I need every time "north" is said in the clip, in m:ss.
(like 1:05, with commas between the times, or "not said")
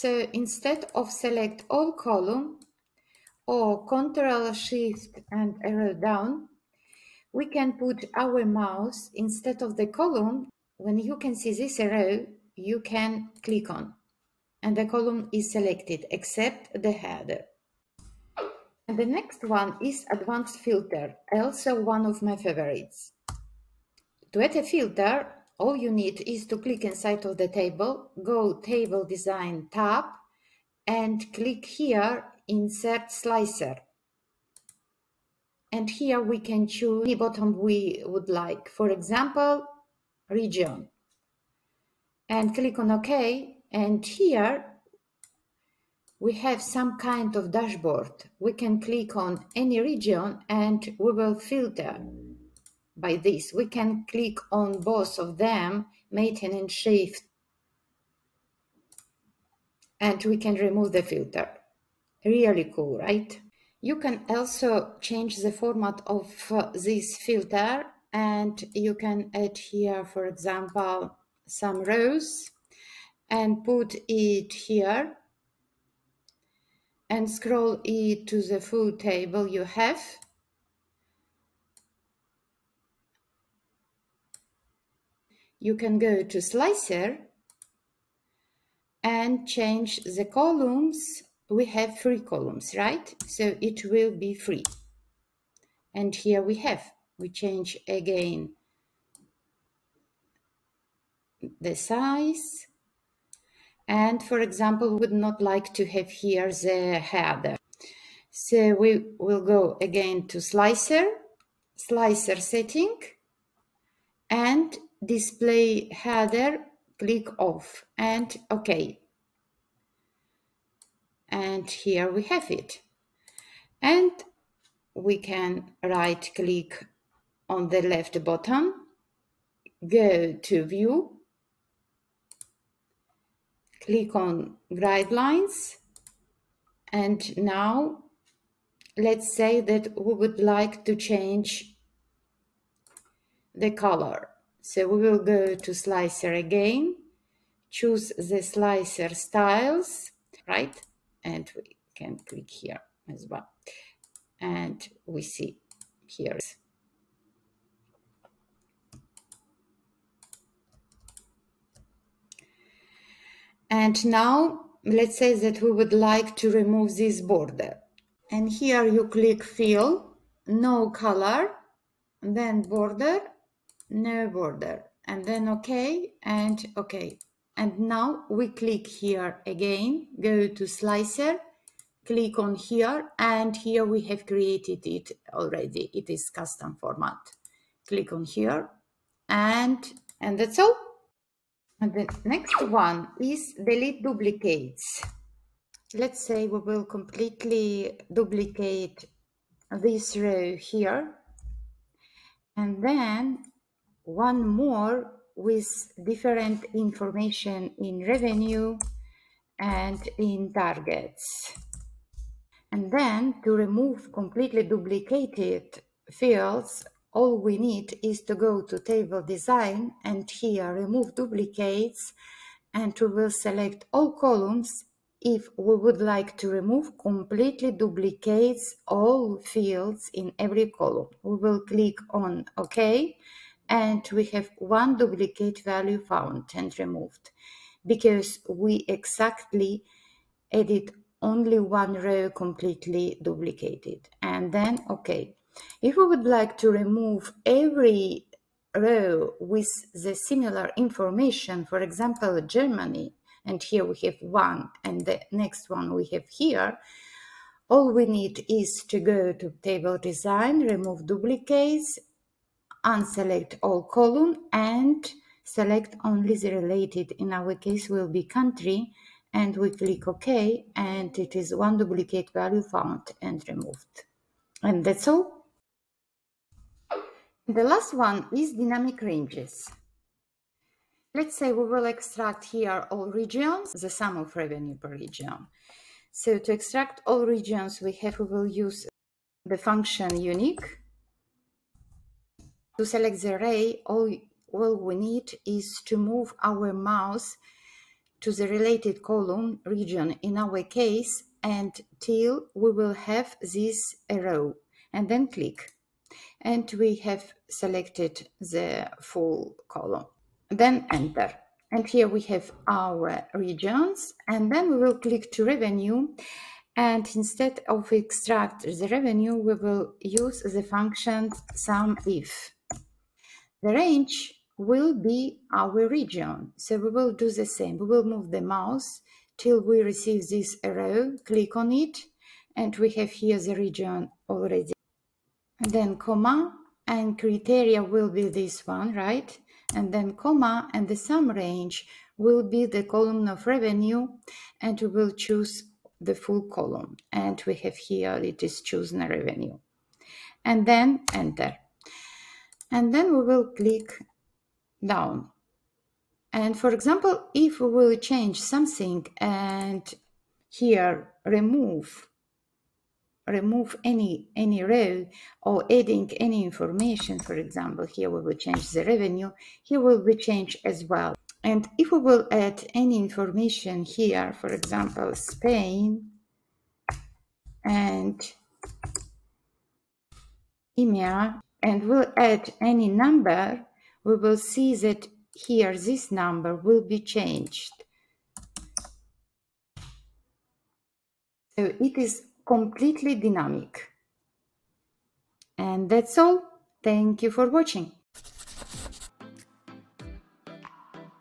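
not said.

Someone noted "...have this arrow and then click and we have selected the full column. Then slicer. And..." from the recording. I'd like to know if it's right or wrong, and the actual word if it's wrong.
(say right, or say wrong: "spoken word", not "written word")
wrong: "enter", not "slicer".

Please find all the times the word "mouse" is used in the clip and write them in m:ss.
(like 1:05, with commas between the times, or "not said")
0:08, 4:56, 5:28.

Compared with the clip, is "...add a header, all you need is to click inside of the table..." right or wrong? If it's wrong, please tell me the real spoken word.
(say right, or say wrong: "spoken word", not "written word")
wrong: "filter", not "header".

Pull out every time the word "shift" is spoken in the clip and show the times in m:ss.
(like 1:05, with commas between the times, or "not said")
0:04, 0:56.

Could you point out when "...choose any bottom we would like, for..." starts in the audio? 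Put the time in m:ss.
0:36.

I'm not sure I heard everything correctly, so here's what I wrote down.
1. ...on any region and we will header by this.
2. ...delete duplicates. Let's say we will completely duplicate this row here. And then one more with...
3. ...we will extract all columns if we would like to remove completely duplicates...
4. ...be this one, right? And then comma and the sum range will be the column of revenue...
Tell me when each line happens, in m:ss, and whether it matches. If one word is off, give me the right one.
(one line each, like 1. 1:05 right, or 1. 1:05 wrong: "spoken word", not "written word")
1. 0:49 wrong: "filter", not "header"
2. 3:13 right
3. 3:42 wrong: "select", not "extract"
4. 5:38 right.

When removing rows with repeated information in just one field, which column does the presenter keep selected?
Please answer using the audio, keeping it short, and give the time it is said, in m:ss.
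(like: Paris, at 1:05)
Country, at 4:28.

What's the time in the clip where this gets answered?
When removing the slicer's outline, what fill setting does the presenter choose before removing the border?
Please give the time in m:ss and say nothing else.
2:50.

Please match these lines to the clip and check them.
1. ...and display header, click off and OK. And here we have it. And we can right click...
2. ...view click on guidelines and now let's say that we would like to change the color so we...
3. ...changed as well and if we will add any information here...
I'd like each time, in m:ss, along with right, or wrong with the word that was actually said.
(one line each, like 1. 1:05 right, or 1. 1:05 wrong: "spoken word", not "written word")
1. 1:54 right
2. 2:10 right
3. 6:10 right.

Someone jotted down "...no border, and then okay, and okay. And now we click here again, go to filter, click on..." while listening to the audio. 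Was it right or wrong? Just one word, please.
wrong.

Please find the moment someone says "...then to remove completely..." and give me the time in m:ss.
3:32.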